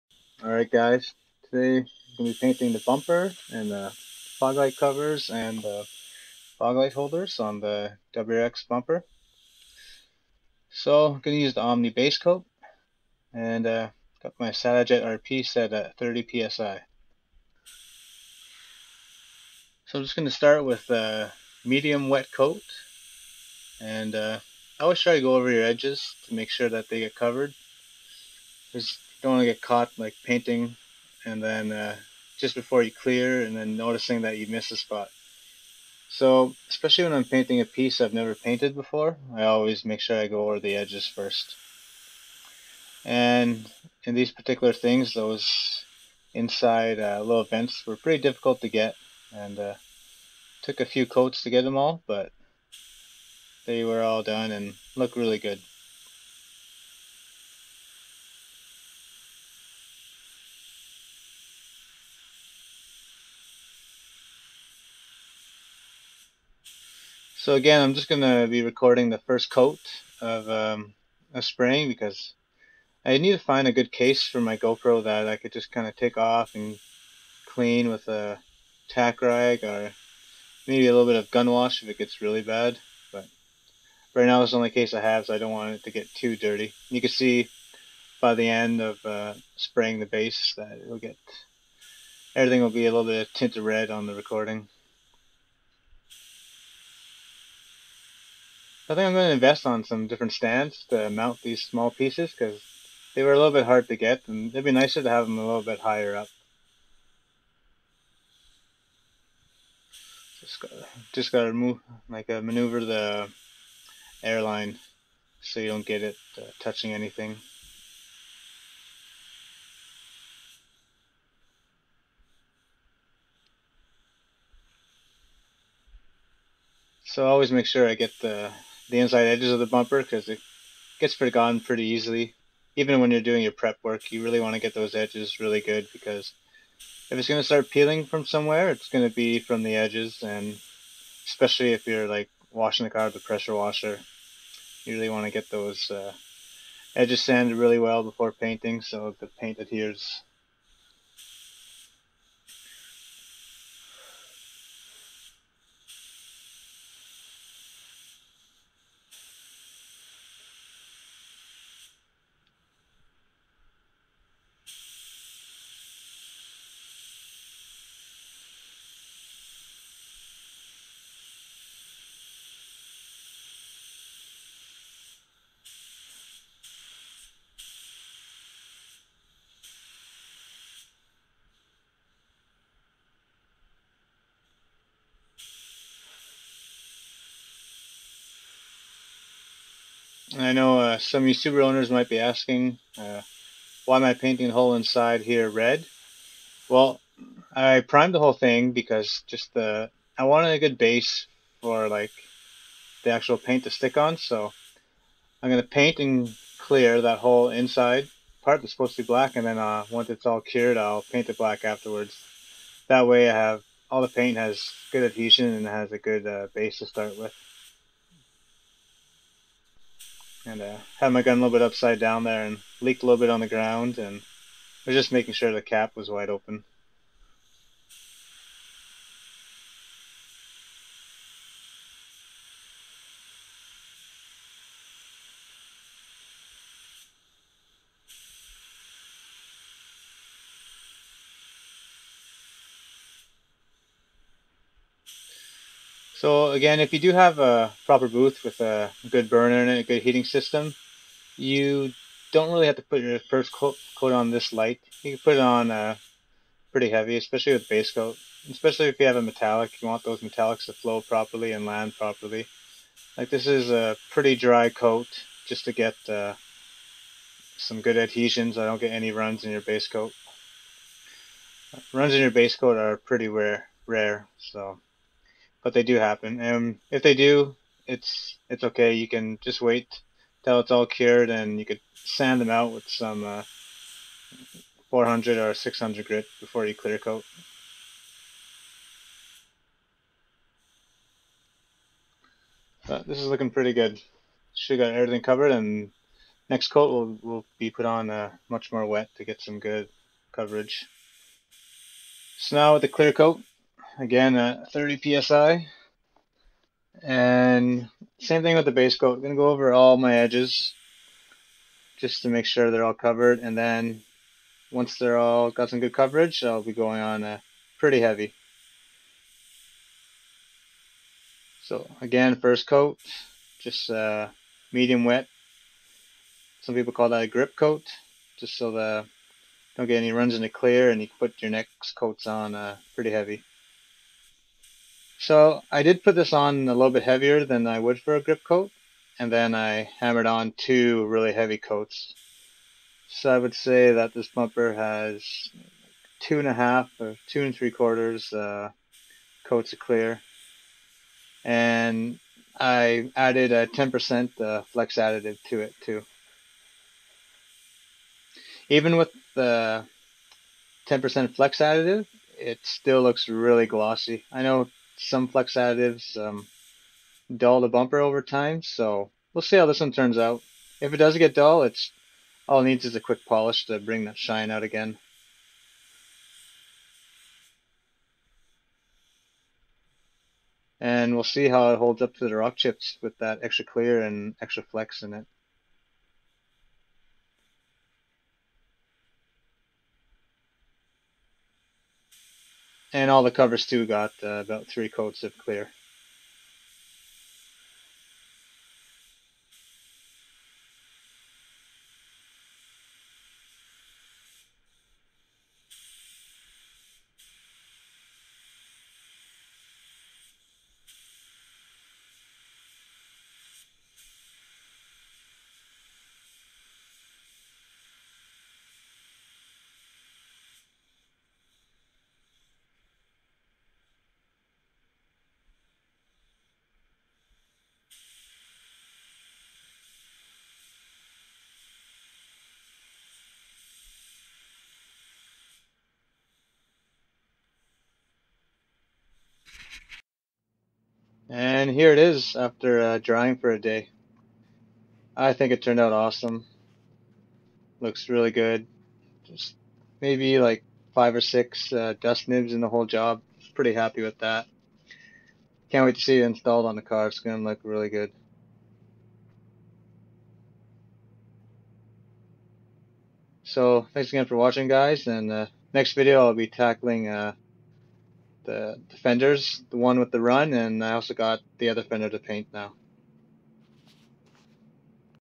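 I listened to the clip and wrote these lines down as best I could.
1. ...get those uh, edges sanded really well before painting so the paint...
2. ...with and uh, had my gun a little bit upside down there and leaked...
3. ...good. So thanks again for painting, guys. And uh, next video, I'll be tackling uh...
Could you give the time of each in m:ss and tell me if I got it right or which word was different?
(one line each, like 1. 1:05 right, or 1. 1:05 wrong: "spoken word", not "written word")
1. 2:25 right
2. 3:37 right
3. 7:37 wrong: "watching", not "painting".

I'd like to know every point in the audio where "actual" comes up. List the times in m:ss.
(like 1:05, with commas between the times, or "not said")
3:23.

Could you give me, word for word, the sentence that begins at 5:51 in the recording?
And I added a 10% uh, flex additive to it too.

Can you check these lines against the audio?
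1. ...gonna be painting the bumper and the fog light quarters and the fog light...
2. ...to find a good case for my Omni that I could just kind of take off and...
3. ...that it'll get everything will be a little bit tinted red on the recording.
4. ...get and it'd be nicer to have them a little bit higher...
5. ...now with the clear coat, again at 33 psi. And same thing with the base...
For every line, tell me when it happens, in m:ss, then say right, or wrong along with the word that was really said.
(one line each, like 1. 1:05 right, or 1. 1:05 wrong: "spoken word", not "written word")
1. 0:02 wrong: "covers", not "quarters"
2. 1:13 wrong: "GoPro", not "Omni"
3. 1:30 right
4. 1:43 right
5. 5:02 wrong: "30", not "33".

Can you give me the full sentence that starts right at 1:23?
But right now it's the only case I have, so I don't want it to get too dirty.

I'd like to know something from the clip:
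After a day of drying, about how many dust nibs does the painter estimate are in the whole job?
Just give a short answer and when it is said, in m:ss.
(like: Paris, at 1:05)
5 or 6, at 7:30.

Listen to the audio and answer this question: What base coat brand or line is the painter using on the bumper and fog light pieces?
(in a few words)
Omni.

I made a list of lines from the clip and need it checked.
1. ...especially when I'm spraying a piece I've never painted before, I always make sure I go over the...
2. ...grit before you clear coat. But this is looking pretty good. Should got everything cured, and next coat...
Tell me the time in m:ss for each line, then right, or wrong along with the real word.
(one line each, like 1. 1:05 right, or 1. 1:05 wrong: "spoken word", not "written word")
1. 0:36 wrong: "painting", not "spraying"
2. 4:46 wrong: "covered", not "cured".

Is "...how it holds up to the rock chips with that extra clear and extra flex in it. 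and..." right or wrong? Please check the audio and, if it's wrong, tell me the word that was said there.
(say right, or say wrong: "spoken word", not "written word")
right.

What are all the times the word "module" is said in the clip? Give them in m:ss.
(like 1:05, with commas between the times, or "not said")
not said.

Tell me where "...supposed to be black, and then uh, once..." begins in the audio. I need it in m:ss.
3:28.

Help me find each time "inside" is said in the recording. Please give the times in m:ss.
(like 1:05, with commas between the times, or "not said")
0:46, 2:08, 3:14, 3:27.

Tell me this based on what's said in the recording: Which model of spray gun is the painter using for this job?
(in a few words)
Satajet RP.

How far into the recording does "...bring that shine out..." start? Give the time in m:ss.
6:13.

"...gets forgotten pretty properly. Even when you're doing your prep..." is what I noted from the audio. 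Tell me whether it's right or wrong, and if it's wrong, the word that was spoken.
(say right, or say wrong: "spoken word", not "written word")
wrong: "easily", not "properly".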